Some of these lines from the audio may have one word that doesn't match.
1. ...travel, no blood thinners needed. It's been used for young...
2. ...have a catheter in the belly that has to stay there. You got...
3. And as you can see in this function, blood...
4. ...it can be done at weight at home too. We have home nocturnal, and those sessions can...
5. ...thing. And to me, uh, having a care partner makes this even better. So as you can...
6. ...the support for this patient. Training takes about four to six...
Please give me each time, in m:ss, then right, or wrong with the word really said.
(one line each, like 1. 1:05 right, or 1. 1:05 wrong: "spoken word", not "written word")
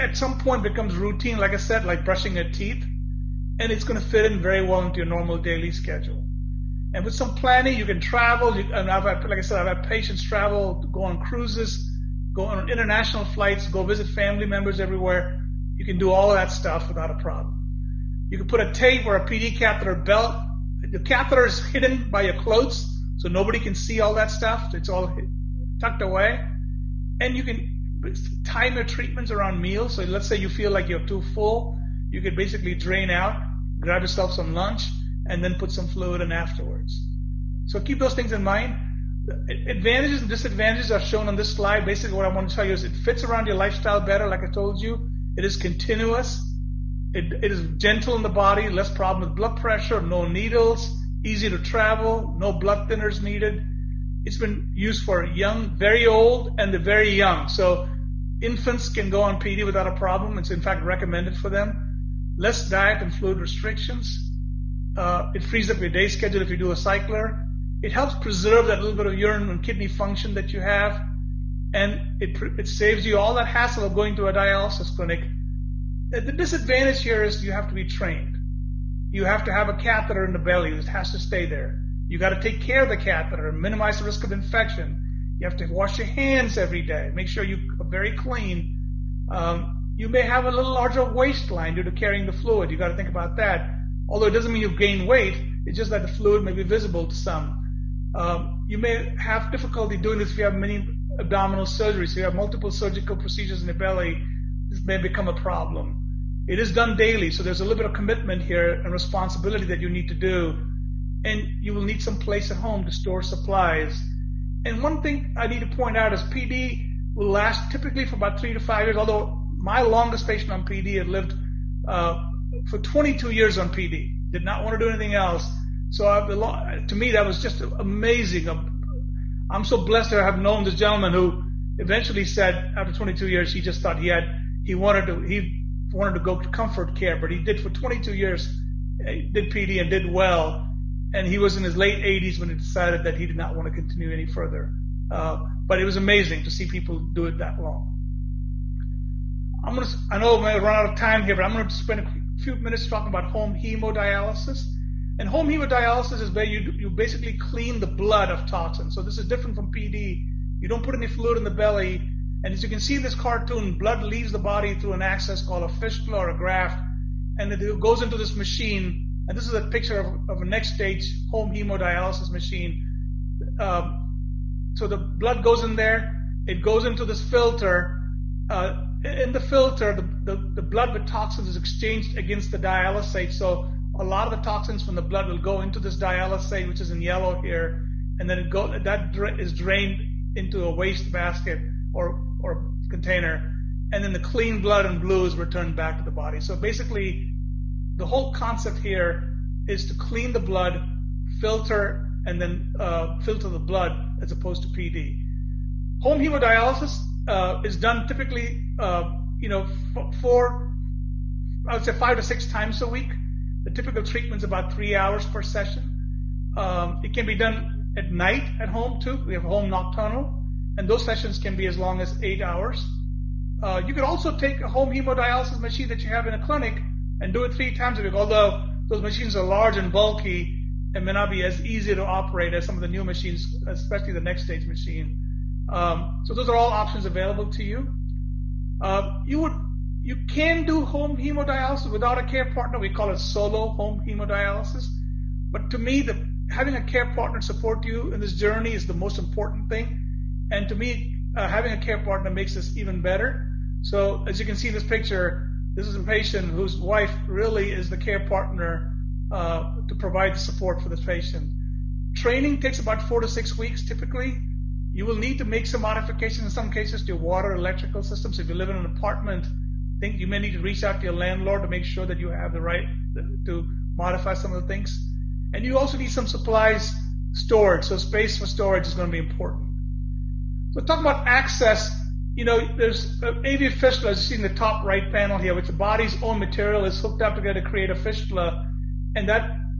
1. 0:51 right
2. 1:19 right
3. 2:42 wrong: "cartoon", not "function"
4. 3:37 wrong: "night", not "weight"
5. 4:09 right
6. 4:20 right.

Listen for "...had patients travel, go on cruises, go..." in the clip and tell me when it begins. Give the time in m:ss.
0:09.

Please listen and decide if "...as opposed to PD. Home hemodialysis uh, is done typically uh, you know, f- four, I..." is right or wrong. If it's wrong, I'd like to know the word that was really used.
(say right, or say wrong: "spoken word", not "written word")
right.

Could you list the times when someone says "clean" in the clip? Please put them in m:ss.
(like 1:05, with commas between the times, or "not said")
1:28, 2:37, 3:14, 3:19.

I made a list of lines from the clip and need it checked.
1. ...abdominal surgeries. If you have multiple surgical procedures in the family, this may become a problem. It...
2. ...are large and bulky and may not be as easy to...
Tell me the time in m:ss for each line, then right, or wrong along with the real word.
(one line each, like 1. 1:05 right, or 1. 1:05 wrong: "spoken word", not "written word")
1. 1:41 wrong: "belly", not "family"
2. 3:49 right.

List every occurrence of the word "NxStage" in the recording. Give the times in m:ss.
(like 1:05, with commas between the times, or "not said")
2:50, 3:54.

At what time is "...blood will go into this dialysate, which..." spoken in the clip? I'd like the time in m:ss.
3:05.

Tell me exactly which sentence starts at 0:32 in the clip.
You could basically drain out, grab yourself some lunch and then put some fluid in afterwards.